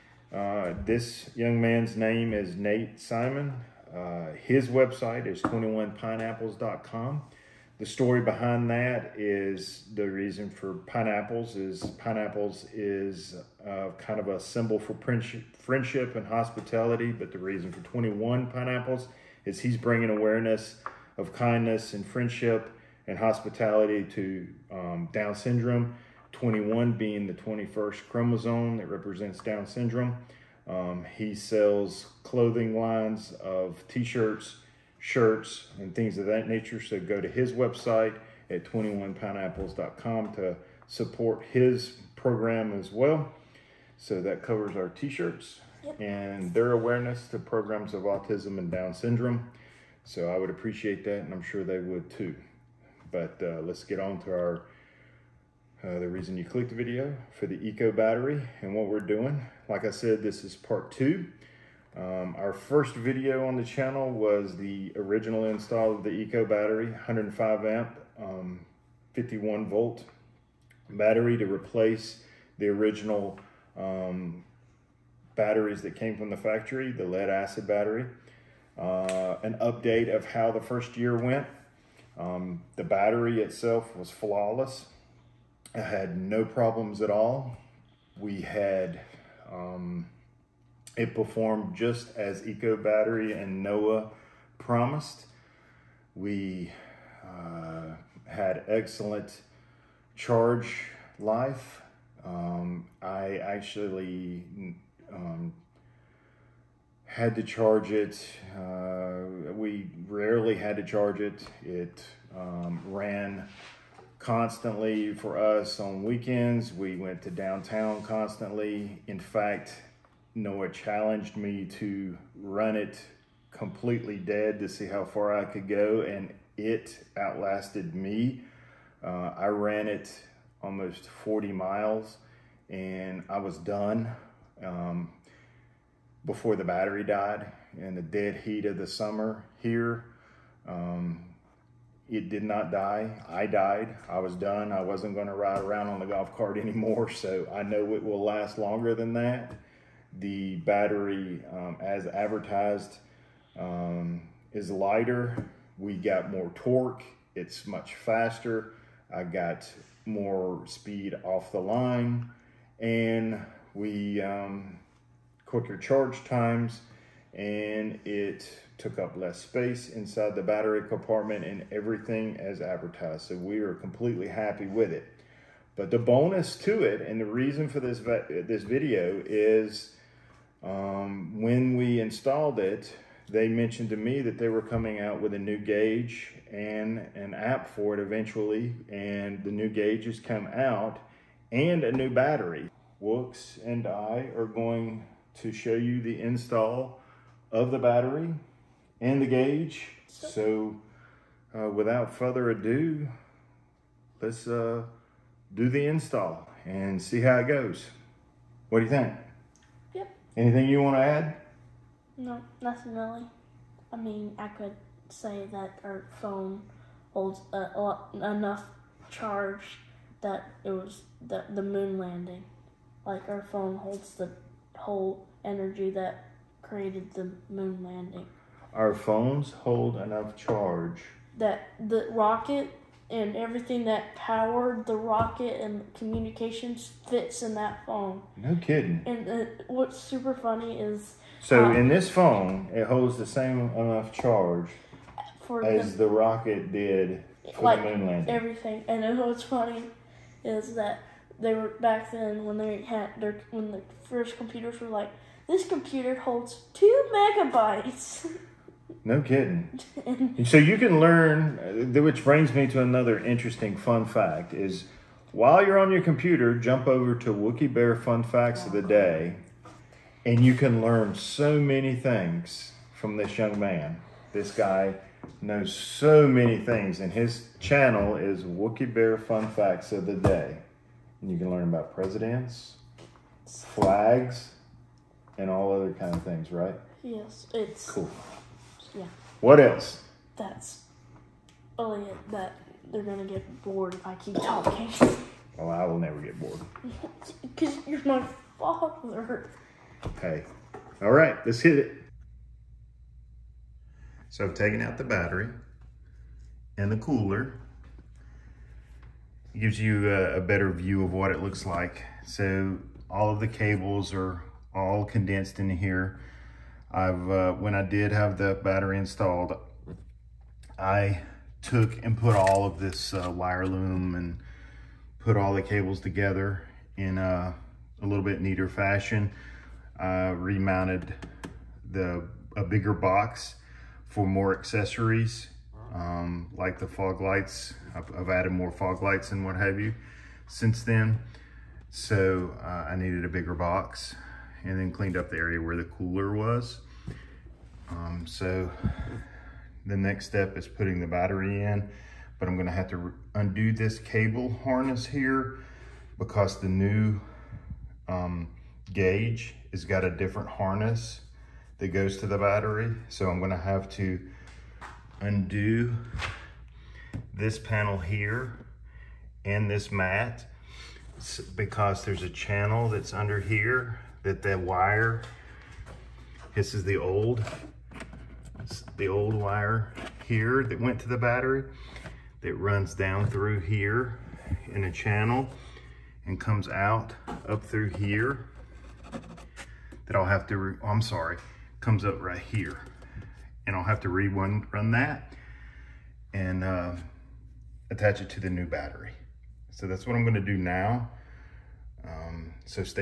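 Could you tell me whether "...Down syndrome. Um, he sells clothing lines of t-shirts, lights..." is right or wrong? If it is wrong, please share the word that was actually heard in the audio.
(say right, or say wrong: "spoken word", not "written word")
wrong: "shirts", not "lights".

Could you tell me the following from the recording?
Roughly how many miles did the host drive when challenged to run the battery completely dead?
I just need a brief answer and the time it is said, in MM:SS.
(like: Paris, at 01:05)
40 miles, at 02:11.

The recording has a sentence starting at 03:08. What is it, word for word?
And the new gauge has come out and a new battery.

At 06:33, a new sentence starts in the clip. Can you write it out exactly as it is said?
And I'll have to re run that and uh, attach it to the new battery.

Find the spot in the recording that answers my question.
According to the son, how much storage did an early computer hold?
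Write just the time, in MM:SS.
04:16.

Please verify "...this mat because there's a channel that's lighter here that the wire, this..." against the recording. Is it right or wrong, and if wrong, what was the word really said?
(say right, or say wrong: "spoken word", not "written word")
wrong: "under", not "lighter".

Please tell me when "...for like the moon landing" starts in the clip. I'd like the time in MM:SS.
04:07.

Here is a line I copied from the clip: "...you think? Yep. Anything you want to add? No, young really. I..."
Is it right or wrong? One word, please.
wrong.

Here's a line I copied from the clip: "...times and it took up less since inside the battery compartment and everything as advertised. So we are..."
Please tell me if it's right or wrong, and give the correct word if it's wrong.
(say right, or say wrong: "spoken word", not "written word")
wrong: "space", not "since".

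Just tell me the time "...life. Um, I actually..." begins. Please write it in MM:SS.
01:41.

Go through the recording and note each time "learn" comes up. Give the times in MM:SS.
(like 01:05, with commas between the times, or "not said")
04:20, 04:30, 04:41.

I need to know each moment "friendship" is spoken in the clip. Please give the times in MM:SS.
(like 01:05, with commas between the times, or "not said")
00:15, 00:22.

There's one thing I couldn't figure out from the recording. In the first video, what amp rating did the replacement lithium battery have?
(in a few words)
105 amp.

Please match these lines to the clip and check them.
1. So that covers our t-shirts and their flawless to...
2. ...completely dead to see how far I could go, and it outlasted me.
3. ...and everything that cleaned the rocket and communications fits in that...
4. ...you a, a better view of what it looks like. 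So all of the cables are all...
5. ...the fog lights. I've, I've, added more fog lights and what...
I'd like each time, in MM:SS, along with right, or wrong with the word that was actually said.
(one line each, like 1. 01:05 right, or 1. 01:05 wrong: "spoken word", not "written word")
1. 00:43 wrong: "awareness", not "flawless"
2. 02:03 right
3. 03:53 wrong: "powered", not "cleaned"
4. 05:09 right
5. 05:36 right.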